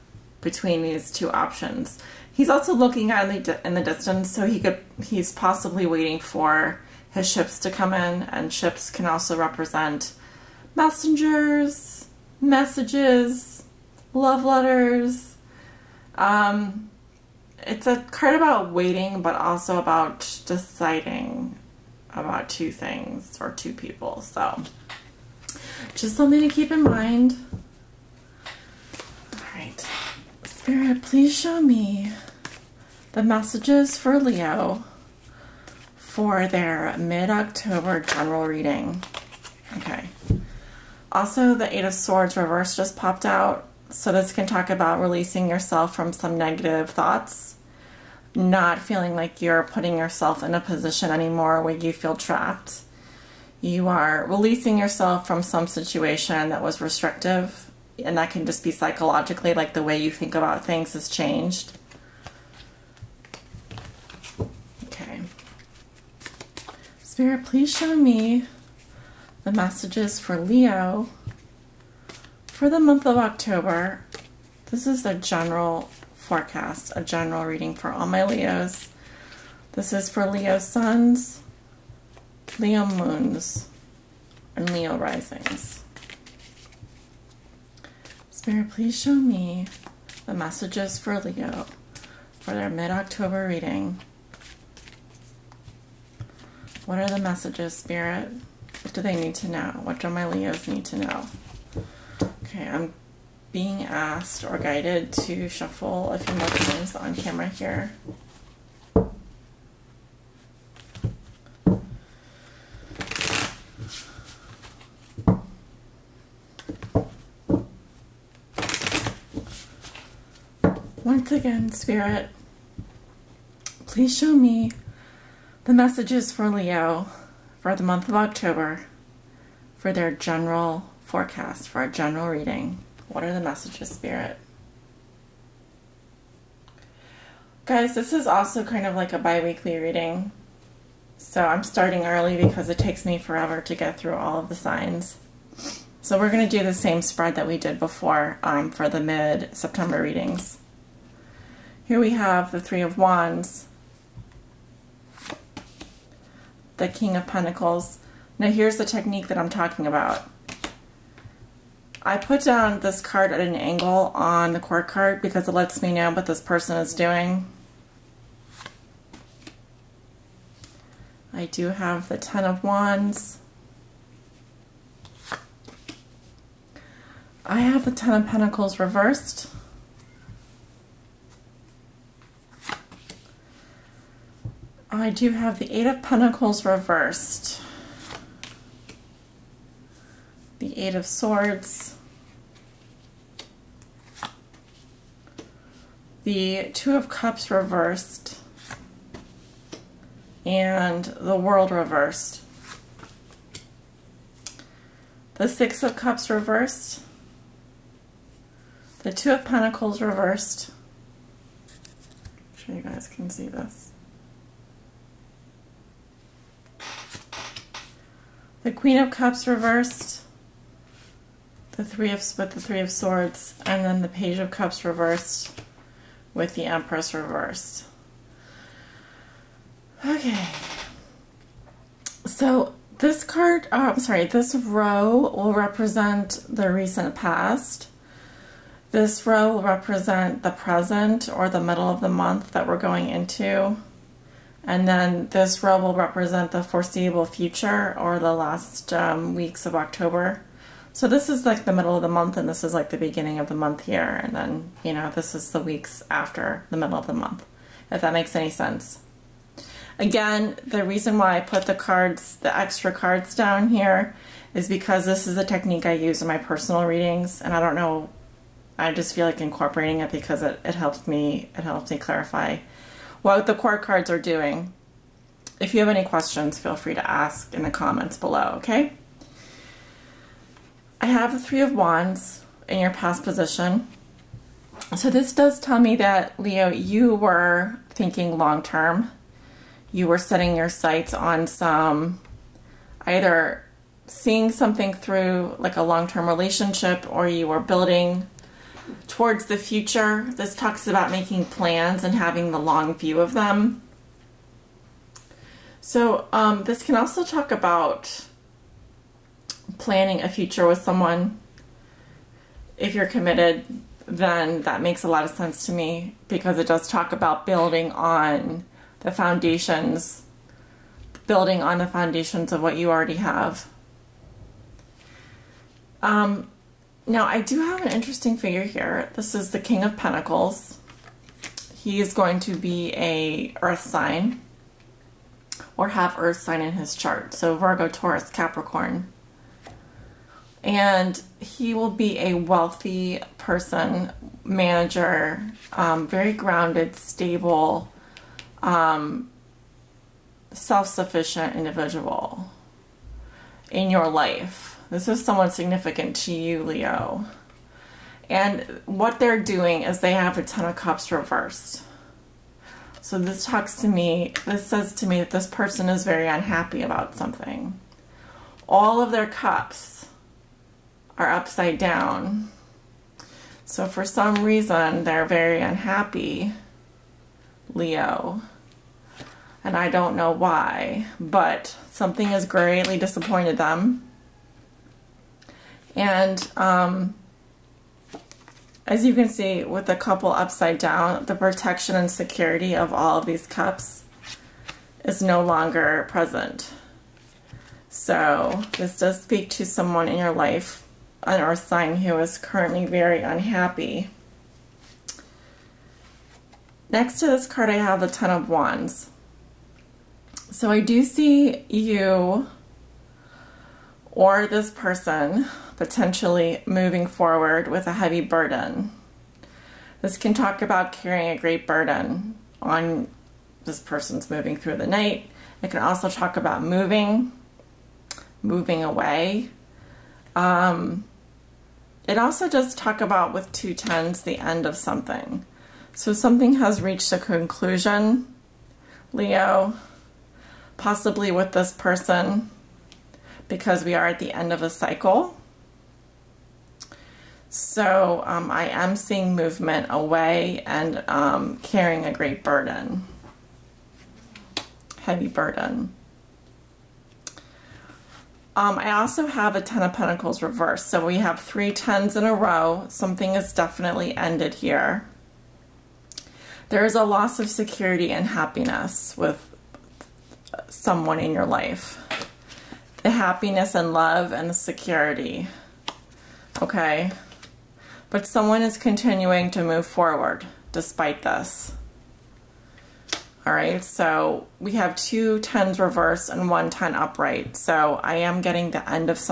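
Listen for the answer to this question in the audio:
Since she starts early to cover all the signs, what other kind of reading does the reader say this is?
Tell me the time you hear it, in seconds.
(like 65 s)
139 s.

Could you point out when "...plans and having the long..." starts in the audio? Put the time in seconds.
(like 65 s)
301 s.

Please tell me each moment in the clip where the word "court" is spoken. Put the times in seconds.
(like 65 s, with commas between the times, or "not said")
164 s.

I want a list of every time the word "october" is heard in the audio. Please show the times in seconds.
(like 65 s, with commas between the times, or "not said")
36 s, 73 s, 92 s, 128 s, 249 s.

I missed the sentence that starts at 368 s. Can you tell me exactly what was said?
All of their cups are upside down.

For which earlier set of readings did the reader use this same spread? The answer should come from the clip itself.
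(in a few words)
mid-September.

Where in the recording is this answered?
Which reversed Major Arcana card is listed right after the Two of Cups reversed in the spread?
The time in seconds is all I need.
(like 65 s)
201 s.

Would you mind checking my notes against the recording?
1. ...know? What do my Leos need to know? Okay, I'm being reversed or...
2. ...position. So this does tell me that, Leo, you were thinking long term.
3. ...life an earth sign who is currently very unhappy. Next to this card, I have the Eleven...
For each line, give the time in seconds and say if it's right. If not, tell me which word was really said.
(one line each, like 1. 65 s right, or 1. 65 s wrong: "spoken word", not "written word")
1. 99 s wrong: "asked", not "reversed"
2. 283 s right
3. 400 s wrong: "Ten", not "Eleven".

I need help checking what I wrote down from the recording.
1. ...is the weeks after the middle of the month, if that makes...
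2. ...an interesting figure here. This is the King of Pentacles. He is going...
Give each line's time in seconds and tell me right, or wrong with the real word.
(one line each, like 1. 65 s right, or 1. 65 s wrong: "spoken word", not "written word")
1. 255 s right
2. 327 s right.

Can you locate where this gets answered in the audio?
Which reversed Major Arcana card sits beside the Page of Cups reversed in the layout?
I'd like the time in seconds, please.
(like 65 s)
226 s.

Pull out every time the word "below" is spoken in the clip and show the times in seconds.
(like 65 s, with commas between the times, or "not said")
278 s.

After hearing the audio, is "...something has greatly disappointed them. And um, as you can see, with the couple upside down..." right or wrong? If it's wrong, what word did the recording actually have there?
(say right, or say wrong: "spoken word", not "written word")
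right.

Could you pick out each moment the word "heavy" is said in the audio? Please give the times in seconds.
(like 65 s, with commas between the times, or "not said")
417 s, 455 s.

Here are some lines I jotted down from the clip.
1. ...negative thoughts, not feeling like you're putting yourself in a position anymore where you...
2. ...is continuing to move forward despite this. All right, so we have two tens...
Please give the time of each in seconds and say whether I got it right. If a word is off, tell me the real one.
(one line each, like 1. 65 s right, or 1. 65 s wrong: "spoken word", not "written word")
1. 46 s right
2. 478 s right.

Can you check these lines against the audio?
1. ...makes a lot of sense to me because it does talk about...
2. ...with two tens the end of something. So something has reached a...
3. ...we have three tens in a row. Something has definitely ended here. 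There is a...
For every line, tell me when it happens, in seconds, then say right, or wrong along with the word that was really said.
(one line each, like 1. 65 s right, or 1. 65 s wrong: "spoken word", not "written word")
1. 314 s right
2. 433 s right
3. 461 s right.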